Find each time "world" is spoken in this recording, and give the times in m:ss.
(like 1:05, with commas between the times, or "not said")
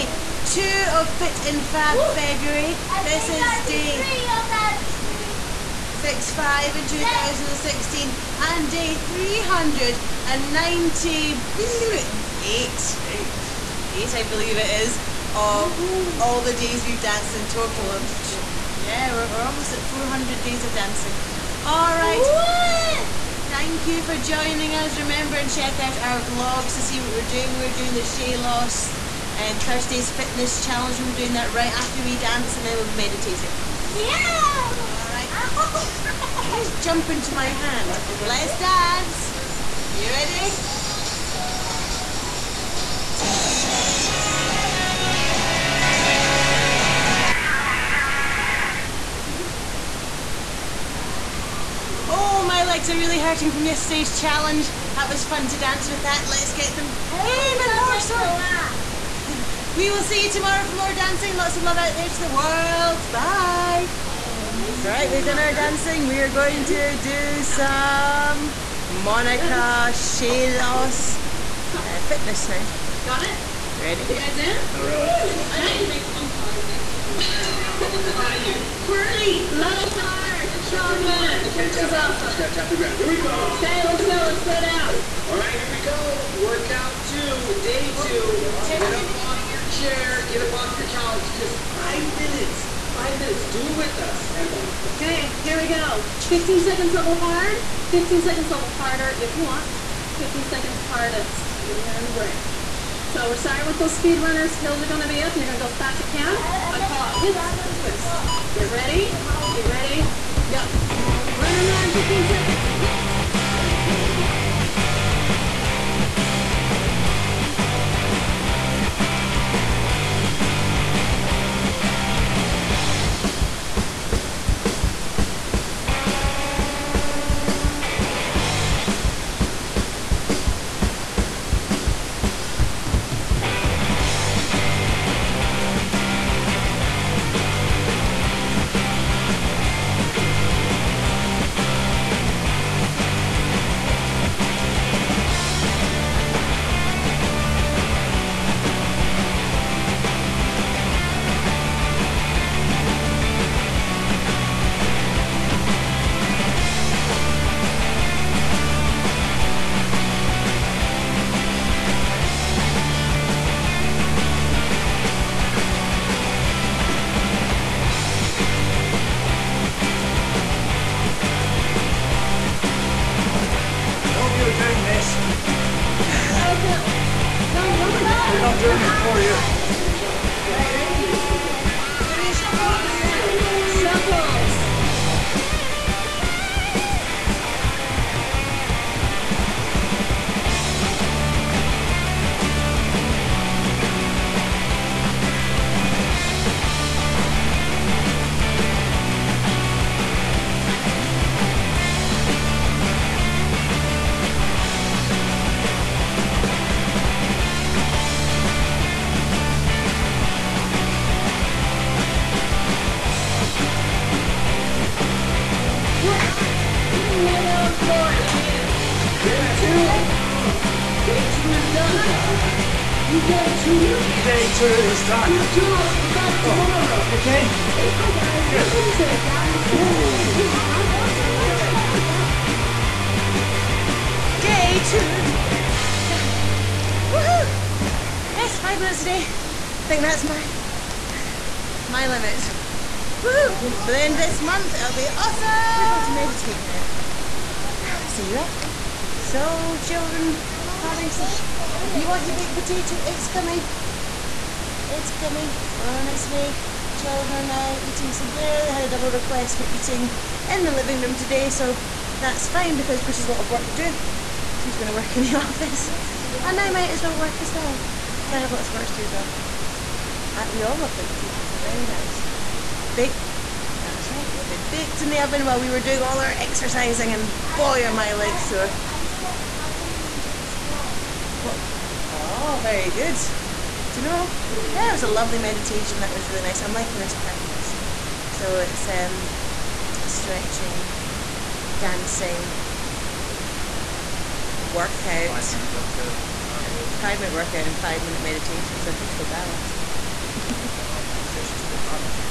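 1:02.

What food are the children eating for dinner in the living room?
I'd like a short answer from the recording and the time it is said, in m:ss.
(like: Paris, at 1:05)
baked potatoes, at 4:30.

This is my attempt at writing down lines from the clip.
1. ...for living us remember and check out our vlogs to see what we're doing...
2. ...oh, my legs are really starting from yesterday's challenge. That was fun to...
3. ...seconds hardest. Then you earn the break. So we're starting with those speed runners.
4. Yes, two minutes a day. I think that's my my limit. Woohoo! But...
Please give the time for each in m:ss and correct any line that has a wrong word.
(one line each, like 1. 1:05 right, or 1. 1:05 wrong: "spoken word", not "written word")
1. 0:24 wrong: "joining", not "living"
2. 0:52 wrong: "hurting", not "starting"
3. 1:40 right
4. 3:58 wrong: "five", not "two".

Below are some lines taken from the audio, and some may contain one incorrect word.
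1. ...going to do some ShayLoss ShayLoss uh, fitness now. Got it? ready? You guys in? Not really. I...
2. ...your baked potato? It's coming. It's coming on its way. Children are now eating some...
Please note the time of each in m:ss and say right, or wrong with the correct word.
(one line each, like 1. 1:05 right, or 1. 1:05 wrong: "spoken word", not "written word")
1. 1:06 wrong: "Monica", not "ShayLoss"
2. 4:12 right.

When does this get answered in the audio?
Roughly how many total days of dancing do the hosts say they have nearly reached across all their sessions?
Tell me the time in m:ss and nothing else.
0:19.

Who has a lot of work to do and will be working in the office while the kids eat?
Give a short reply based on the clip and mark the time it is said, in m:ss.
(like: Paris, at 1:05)
Bruce, at 4:23.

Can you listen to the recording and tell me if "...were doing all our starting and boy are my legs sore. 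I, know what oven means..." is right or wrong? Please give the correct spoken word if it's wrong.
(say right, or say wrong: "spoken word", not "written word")
wrong: "exercising", not "starting".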